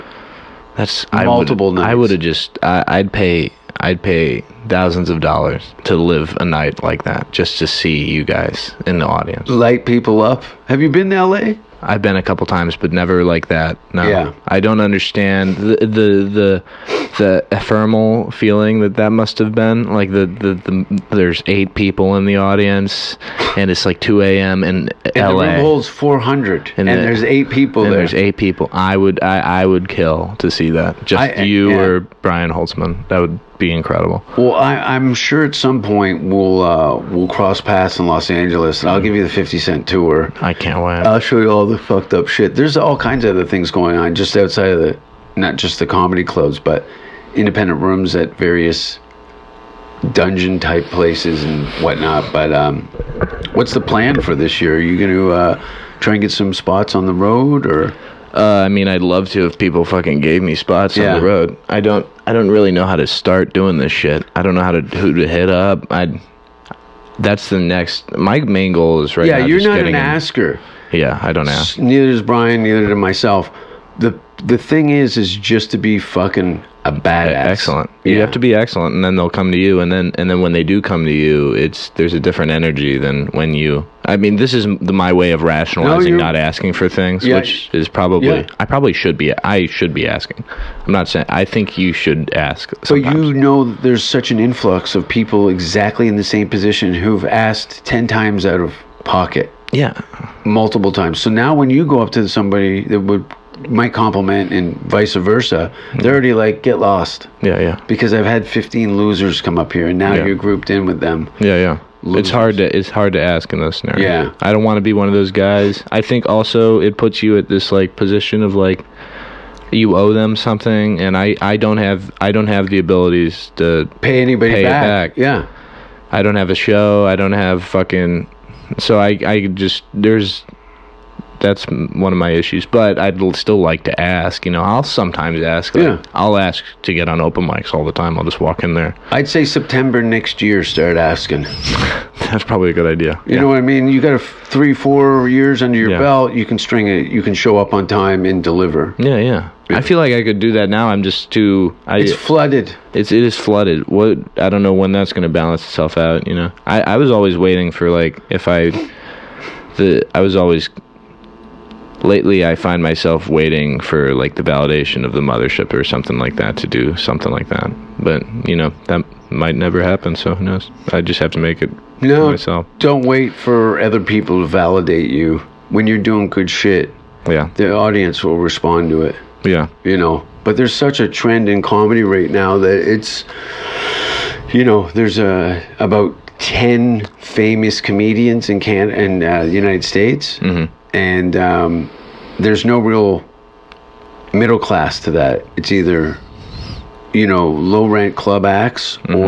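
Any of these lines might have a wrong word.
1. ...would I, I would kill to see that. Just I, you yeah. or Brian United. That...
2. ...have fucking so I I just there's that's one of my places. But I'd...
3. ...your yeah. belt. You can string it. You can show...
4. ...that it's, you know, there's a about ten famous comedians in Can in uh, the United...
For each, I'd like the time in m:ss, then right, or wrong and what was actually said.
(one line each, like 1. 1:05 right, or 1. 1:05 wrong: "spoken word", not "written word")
1. 0:28 wrong: "Holtzman", not "United"
2. 2:07 wrong: "issues", not "places"
3. 2:25 right
4. 3:02 right.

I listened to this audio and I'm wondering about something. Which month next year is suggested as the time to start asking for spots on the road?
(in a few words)
September.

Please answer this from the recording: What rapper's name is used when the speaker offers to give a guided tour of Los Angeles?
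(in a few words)
50 Cent.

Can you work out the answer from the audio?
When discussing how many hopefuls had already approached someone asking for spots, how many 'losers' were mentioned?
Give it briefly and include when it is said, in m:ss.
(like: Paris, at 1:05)
15, at 1:48.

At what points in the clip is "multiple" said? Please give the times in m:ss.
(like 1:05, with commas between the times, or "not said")
0:01, 1:40.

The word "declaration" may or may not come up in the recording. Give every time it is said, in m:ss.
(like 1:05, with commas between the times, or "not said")
not said.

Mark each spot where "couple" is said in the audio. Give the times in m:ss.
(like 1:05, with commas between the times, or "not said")
0:12.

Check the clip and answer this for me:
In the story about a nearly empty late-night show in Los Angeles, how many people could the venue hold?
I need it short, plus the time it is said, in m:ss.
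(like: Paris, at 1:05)
400, at 0:25.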